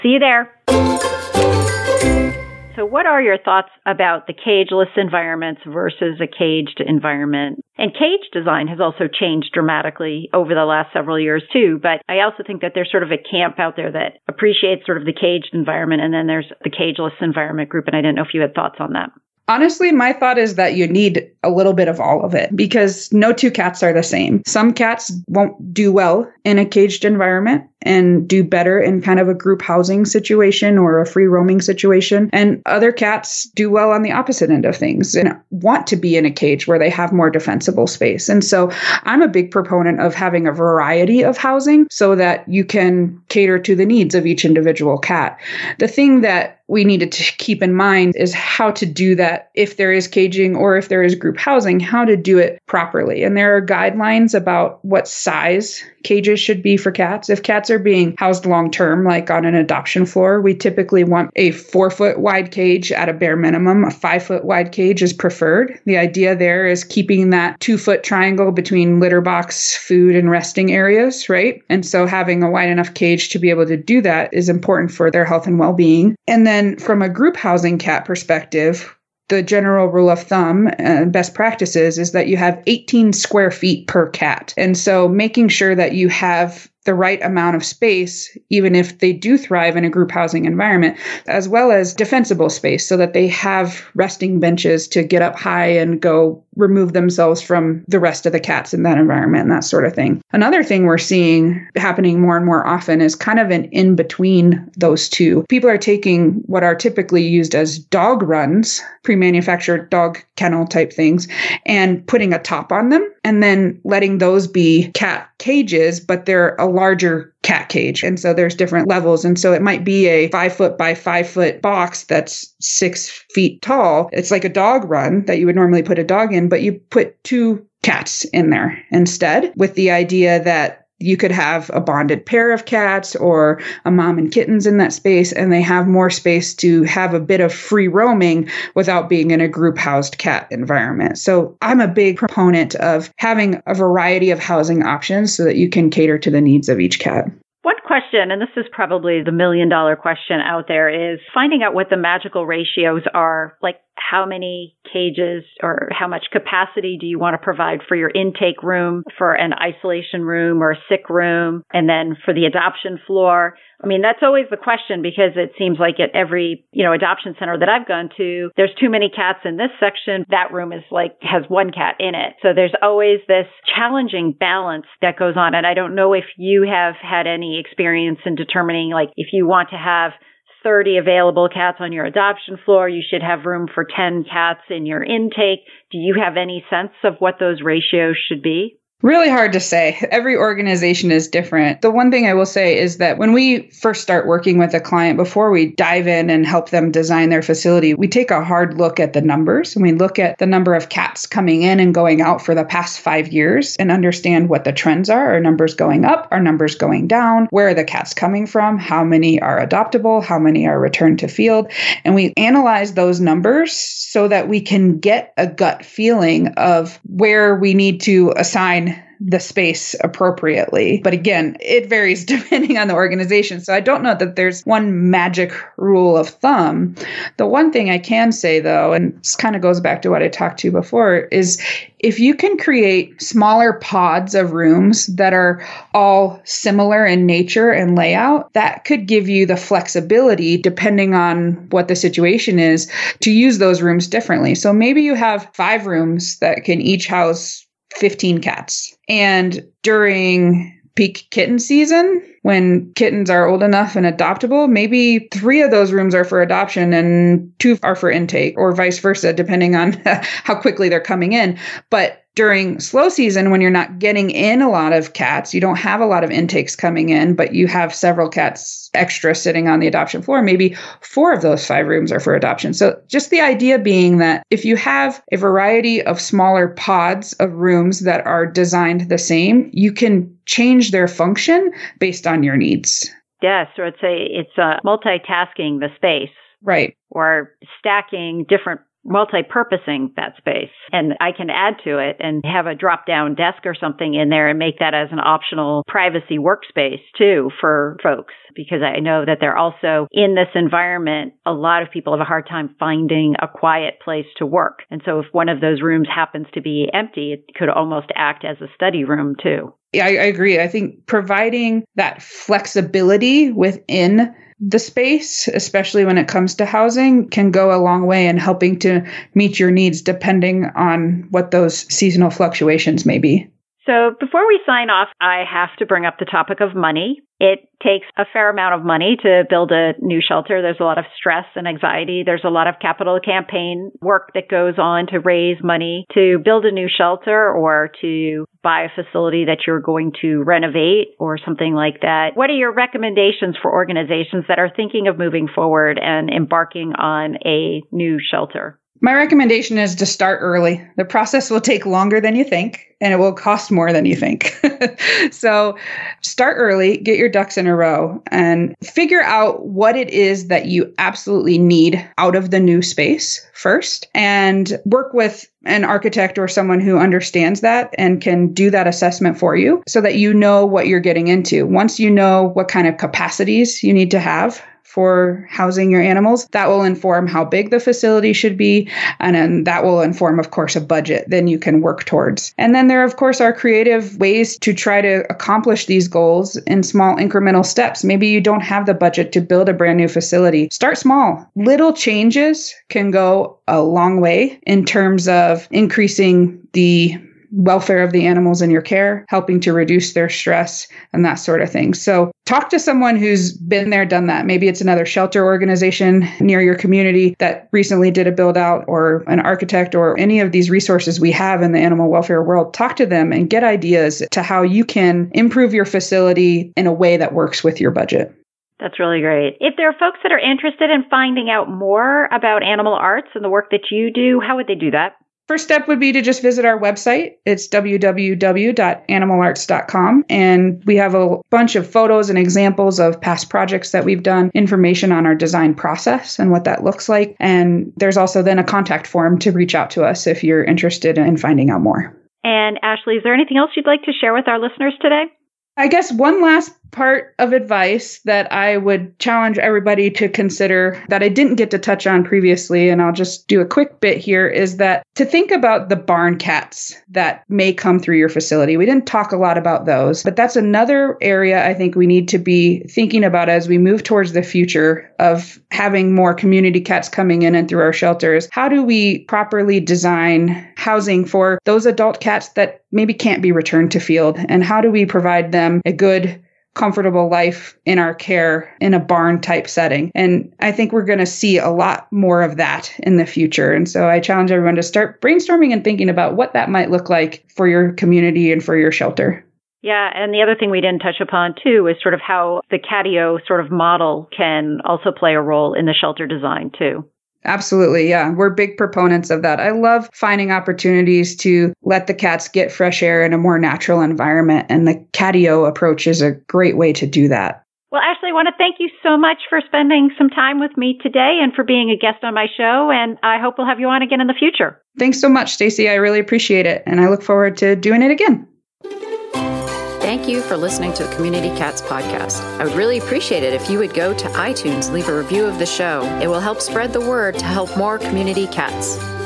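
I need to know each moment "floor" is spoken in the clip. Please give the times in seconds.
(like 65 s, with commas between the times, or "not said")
60 s, 163 s, 182 s, 270 s.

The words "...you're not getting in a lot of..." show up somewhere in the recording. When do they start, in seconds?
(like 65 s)
263 s.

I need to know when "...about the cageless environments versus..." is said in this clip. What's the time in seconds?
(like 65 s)
3 s.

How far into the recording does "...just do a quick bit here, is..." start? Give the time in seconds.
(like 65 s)
453 s.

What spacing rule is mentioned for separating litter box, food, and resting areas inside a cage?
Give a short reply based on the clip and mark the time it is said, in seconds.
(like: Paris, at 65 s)
2 foot triangle, at 67 s.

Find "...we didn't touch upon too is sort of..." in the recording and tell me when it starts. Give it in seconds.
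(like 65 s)
490 s.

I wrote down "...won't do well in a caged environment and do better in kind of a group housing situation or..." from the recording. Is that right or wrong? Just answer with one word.
right.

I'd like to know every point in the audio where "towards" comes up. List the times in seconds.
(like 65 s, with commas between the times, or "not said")
382 s, 464 s.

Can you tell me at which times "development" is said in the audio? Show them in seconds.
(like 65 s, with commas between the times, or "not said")
not said.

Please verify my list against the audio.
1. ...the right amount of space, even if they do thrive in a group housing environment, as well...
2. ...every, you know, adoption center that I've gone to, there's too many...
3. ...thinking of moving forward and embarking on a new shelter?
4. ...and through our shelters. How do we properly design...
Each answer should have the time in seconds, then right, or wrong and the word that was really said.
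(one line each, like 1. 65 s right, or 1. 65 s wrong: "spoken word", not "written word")
1. 86 s right
2. 166 s right
3. 344 s right
4. 467 s right.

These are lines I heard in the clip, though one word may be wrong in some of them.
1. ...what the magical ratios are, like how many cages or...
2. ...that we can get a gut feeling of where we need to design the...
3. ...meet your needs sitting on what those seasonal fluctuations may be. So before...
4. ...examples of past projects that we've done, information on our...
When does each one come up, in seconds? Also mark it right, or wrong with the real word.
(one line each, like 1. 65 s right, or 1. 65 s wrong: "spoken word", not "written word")
1. 151 s right
2. 214 s wrong: "assign", not "design"
3. 319 s wrong: "depending", not "sitting"
4. 432 s right.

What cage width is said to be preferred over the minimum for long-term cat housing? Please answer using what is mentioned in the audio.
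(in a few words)
5 feet.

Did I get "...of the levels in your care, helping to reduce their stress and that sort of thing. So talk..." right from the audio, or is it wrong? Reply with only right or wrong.
wrong.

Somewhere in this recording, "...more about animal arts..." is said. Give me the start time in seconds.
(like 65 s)
421 s.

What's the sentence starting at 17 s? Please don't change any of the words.
And I didn't know if you had thoughts on that.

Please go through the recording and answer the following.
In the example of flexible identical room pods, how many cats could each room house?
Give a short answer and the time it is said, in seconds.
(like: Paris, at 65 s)
15, at 247 s.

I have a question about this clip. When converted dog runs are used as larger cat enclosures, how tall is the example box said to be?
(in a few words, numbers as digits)
6 feet.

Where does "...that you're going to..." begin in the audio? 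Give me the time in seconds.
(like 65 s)
339 s.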